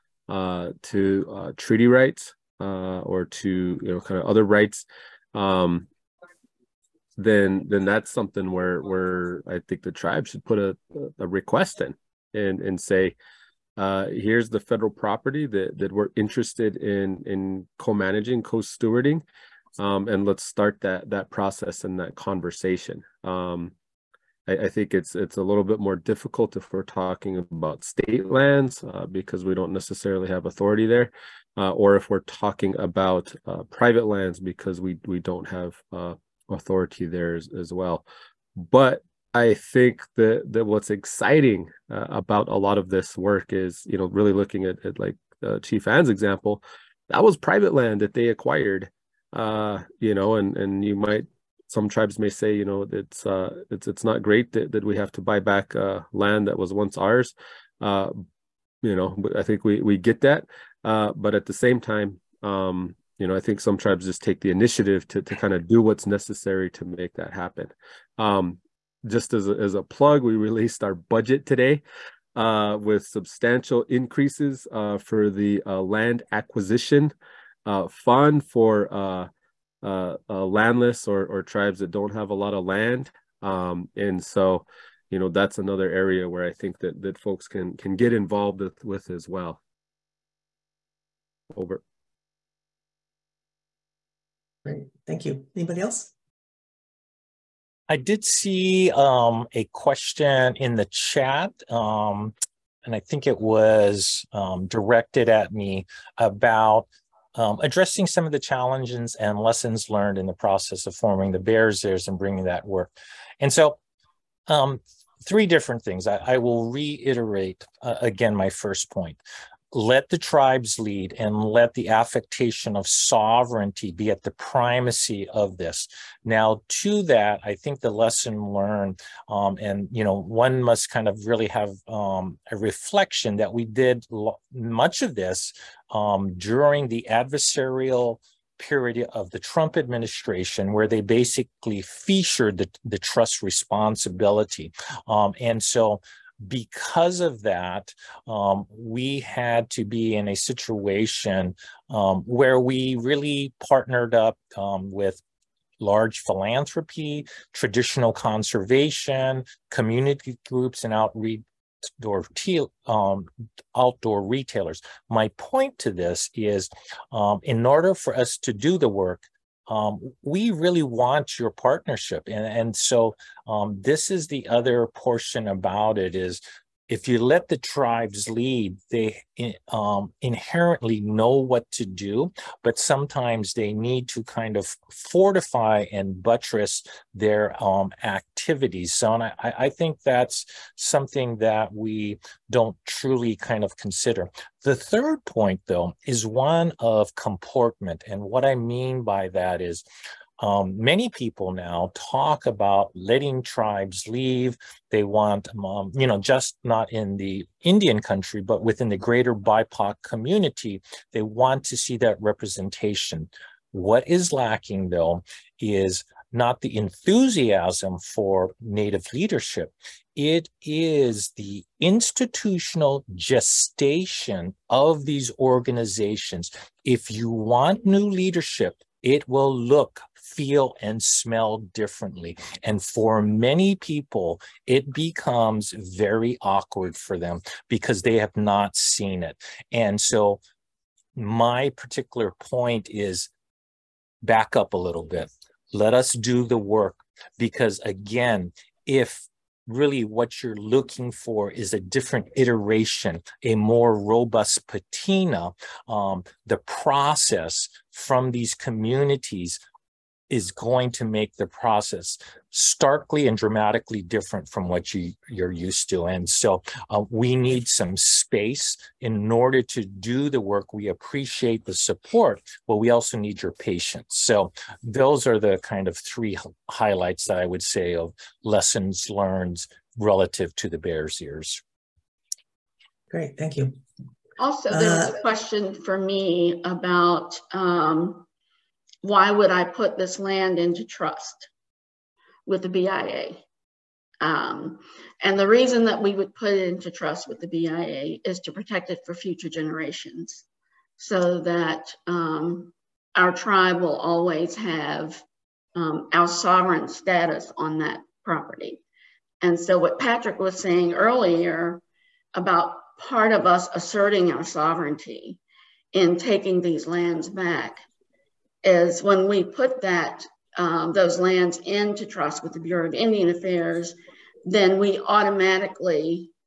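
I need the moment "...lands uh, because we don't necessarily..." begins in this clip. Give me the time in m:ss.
0:28.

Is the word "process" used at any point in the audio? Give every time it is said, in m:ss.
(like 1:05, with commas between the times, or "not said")
0:21, 1:50, 4:16, 4:21.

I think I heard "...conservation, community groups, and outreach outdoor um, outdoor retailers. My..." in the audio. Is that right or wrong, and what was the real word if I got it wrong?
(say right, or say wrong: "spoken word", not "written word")
right.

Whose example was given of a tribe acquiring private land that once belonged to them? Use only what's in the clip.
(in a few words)
Chief Anne.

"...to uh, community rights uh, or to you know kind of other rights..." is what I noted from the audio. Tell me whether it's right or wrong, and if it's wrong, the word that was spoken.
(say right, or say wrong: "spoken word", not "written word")
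wrong: "treaty", not "community".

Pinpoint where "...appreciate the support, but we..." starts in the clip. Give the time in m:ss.
4:30.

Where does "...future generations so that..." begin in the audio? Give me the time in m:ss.
4:59.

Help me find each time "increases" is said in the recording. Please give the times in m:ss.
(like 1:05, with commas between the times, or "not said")
1:13.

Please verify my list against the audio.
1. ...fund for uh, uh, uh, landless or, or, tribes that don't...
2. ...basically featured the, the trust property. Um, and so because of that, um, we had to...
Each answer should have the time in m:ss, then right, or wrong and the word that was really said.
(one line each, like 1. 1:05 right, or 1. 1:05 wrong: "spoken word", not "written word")
1. 1:17 right
2. 2:21 wrong: "responsibility", not "property".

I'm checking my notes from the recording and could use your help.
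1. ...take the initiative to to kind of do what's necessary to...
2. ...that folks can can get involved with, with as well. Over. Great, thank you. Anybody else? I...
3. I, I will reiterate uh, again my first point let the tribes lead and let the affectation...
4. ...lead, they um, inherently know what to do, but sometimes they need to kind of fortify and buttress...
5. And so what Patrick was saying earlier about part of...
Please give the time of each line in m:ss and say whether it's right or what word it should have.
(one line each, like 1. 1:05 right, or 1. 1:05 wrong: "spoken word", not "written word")
1. 1:04 right
2. 1:27 right
3. 1:56 right
4. 2:58 right
5. 5:09 right.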